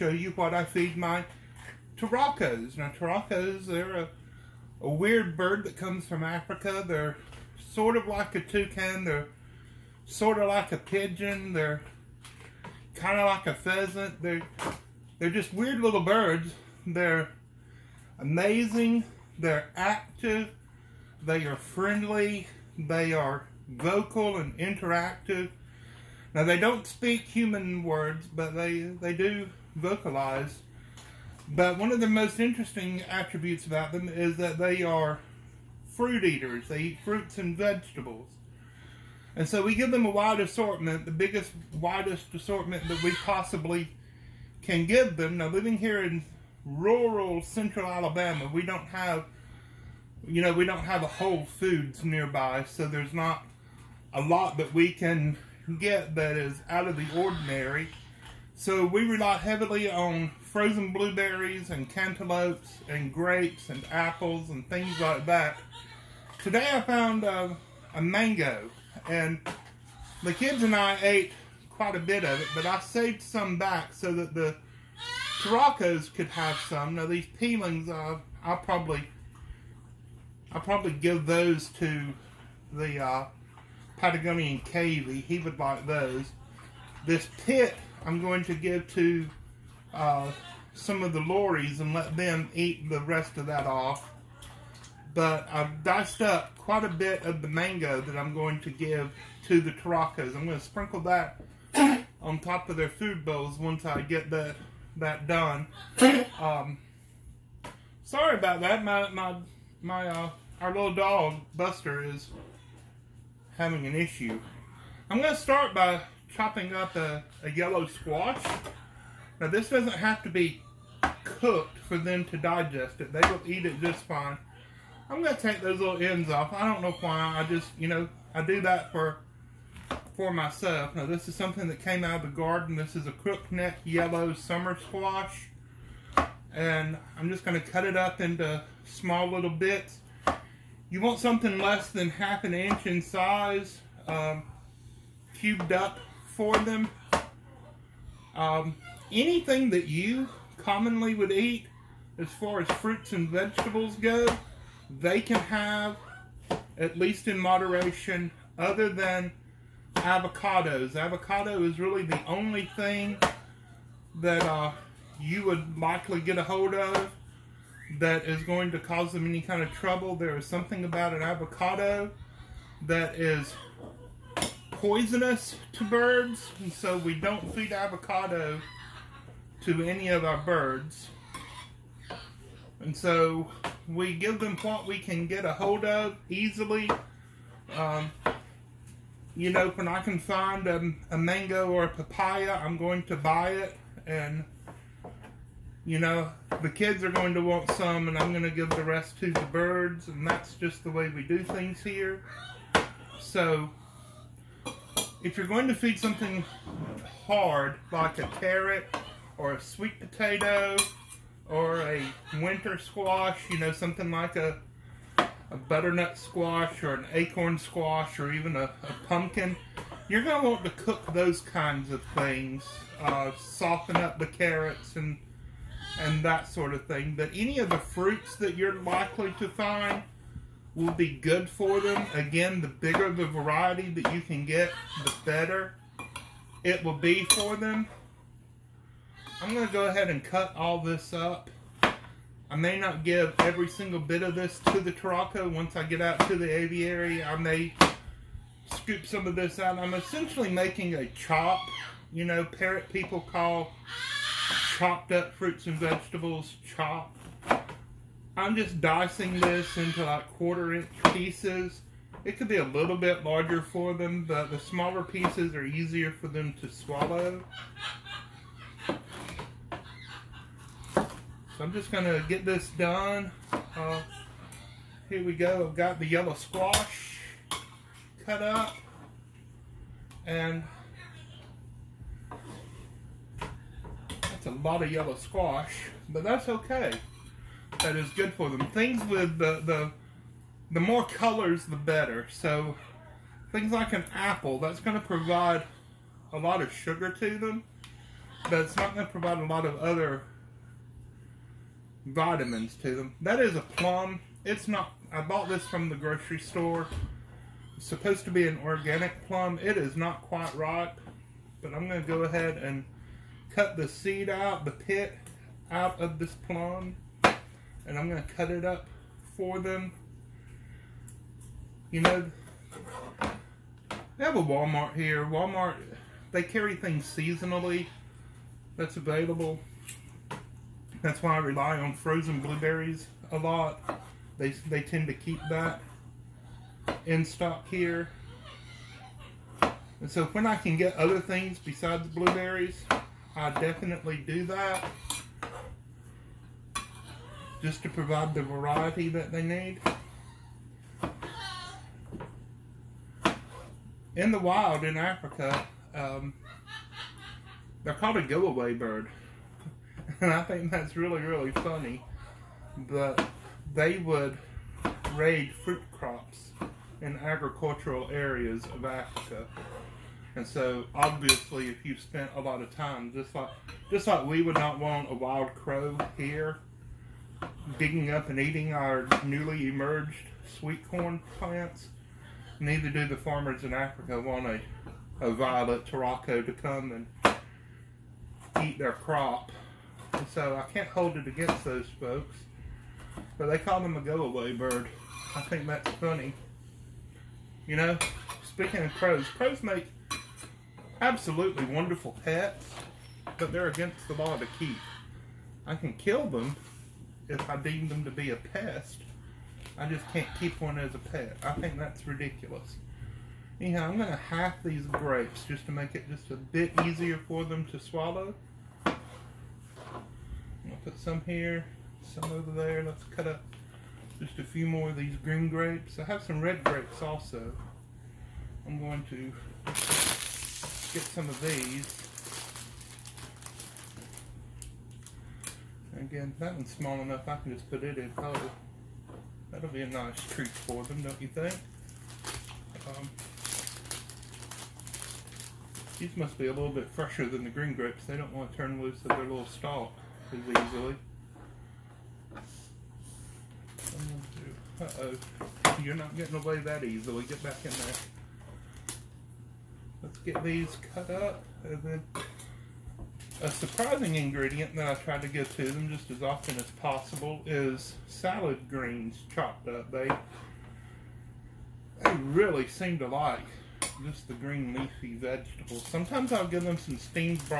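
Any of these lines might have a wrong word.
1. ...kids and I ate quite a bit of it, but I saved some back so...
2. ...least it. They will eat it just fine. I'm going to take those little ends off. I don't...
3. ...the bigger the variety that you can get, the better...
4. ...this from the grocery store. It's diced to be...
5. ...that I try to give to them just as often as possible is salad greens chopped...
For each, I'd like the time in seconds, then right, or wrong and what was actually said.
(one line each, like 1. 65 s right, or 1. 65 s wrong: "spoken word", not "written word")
1. 70 s right
2. 122 s wrong: "digest", not "least"
3. 232 s right
4. 305 s wrong: "supposed", not "diced"
5. 464 s right.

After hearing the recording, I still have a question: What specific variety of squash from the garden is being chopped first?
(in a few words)
crookneck yellow summer squash.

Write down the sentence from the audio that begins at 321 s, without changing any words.
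You know, they have a Walmart here.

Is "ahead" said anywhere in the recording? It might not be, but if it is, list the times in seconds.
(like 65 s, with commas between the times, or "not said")
239 s, 312 s.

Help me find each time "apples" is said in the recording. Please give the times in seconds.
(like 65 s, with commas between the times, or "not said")
63 s, 294 s.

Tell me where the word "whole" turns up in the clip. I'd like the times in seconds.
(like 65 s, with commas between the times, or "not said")
51 s, 438 s.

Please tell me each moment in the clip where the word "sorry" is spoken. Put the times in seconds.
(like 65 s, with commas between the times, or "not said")
108 s.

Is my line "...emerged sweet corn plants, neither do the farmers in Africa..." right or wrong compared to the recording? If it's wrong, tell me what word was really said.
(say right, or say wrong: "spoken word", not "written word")
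right.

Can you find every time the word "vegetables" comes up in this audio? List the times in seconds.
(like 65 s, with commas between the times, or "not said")
37 s, 153 s, 255 s, 475 s.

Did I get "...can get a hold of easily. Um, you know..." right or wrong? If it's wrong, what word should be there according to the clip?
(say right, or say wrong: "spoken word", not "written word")
right.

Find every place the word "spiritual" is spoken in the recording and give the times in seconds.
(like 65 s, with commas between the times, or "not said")
not said.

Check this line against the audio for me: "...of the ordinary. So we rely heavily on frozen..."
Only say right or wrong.
right.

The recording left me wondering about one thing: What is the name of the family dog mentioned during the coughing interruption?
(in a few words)
Buster.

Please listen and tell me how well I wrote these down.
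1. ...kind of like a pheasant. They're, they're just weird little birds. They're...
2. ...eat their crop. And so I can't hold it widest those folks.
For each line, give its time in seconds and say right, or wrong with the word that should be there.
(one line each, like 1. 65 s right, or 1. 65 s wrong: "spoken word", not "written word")
1. 12 s right
2. 388 s wrong: "against", not "widest".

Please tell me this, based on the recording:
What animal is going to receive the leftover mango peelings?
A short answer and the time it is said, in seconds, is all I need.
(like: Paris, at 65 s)
Patagonian Cavy, at 83 s.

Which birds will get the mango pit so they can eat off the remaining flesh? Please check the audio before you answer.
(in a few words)
lorries.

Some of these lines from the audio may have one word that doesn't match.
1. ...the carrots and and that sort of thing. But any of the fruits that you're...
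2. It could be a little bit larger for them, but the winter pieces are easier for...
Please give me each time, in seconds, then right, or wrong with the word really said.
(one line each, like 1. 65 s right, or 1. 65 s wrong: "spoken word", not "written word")
1. 224 s right
2. 262 s wrong: "smaller", not "winter".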